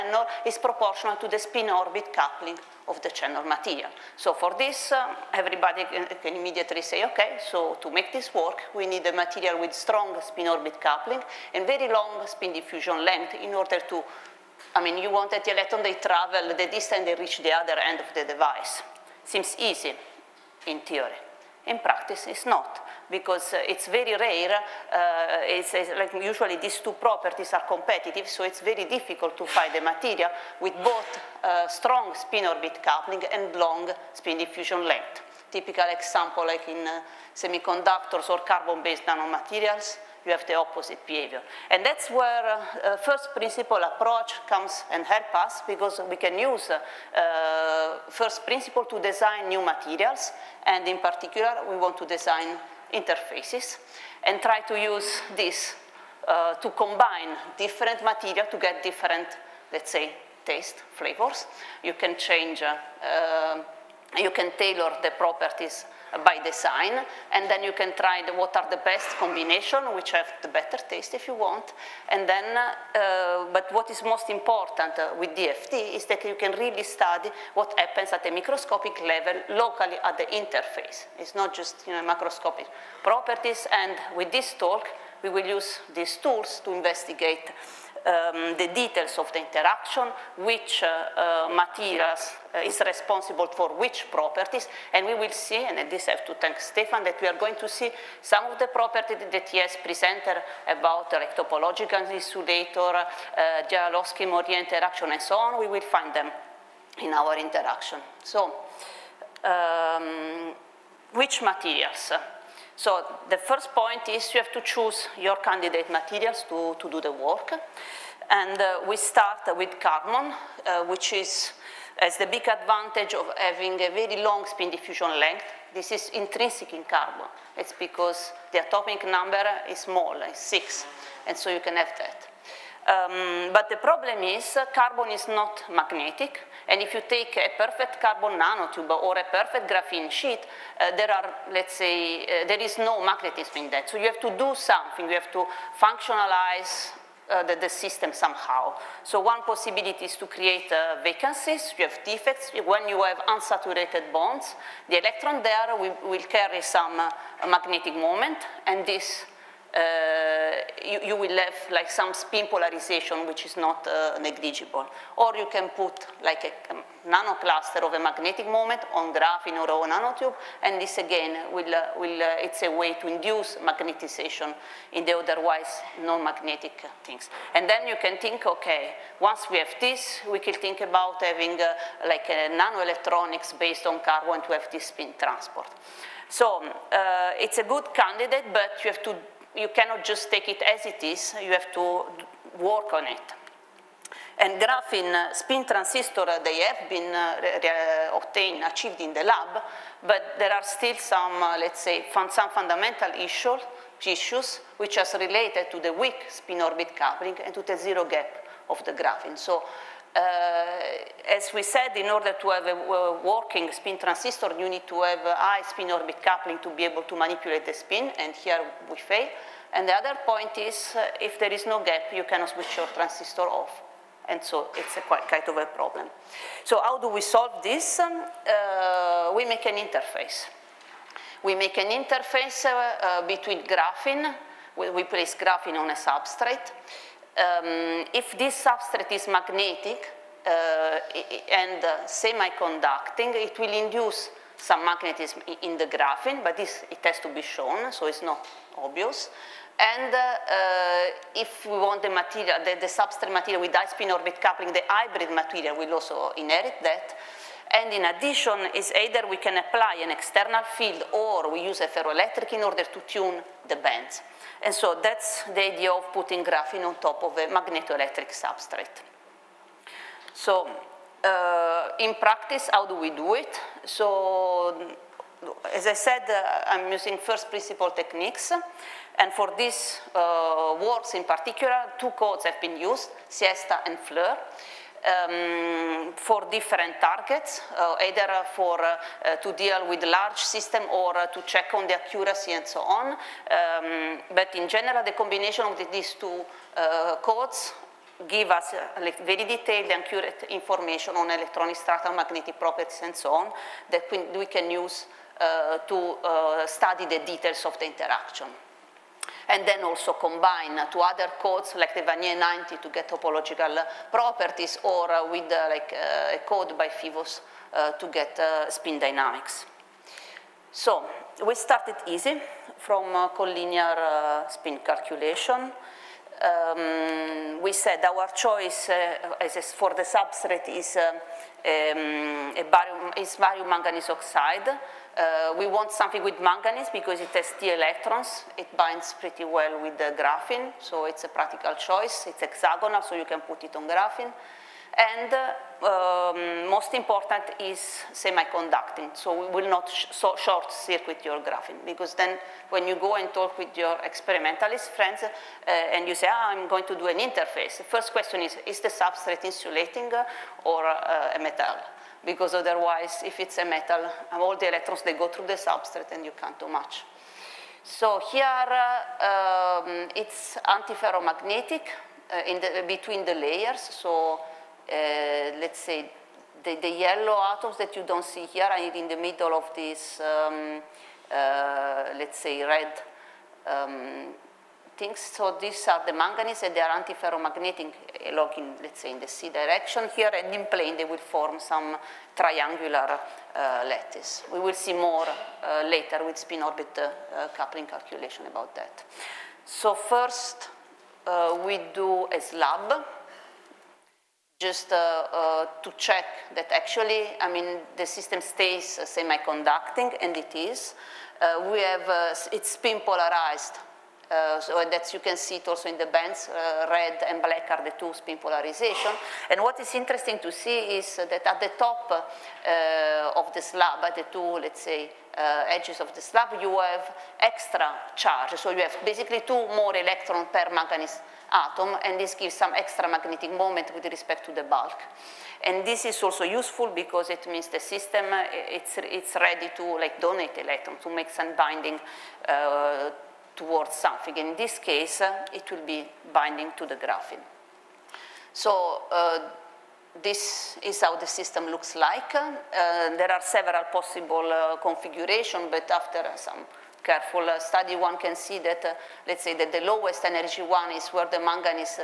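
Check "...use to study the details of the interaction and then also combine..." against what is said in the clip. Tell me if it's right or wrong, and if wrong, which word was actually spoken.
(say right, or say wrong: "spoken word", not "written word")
right.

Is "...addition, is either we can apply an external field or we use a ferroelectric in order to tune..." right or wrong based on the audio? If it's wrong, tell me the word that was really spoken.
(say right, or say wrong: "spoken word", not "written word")
right.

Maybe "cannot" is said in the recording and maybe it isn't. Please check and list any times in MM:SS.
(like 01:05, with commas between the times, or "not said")
03:09, 03:42.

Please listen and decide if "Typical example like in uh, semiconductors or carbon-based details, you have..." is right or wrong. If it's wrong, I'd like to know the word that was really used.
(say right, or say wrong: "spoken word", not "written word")
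wrong: "nanomaterials", not "details".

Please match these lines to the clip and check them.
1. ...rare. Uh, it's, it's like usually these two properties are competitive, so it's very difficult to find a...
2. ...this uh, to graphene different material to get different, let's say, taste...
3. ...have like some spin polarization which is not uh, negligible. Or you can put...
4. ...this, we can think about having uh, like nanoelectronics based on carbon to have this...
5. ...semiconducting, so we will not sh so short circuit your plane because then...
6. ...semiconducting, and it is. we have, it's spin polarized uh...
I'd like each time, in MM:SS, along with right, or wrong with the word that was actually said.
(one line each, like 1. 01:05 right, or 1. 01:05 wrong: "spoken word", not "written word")
1. 00:24 right
2. 00:55 wrong: "combine", not "graphene"
3. 02:41 right
4. 02:59 right
5. 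05:48 wrong: "graphene", not "plane"
6. 06:49 right.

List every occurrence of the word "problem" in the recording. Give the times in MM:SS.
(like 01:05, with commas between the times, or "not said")
02:13, 03:45.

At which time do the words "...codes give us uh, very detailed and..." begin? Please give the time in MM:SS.
04:57.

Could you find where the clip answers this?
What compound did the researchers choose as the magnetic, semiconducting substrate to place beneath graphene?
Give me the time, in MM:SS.
05:33.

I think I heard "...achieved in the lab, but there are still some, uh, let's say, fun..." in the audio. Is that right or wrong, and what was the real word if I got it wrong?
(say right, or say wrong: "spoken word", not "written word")
right.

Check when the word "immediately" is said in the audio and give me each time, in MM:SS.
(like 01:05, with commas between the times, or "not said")
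00:06.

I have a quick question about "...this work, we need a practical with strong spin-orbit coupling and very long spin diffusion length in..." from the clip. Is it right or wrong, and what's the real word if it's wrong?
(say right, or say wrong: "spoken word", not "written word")
wrong: "material", not "practical".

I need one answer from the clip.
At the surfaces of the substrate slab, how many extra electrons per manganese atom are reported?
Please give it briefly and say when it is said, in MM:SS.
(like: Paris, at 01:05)
2, at 07:09.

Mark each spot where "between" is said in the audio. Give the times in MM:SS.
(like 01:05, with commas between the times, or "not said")
03:53, 06:12.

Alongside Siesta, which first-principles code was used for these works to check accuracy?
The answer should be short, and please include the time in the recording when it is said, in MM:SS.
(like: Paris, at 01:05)
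FLEUR, at 04:43.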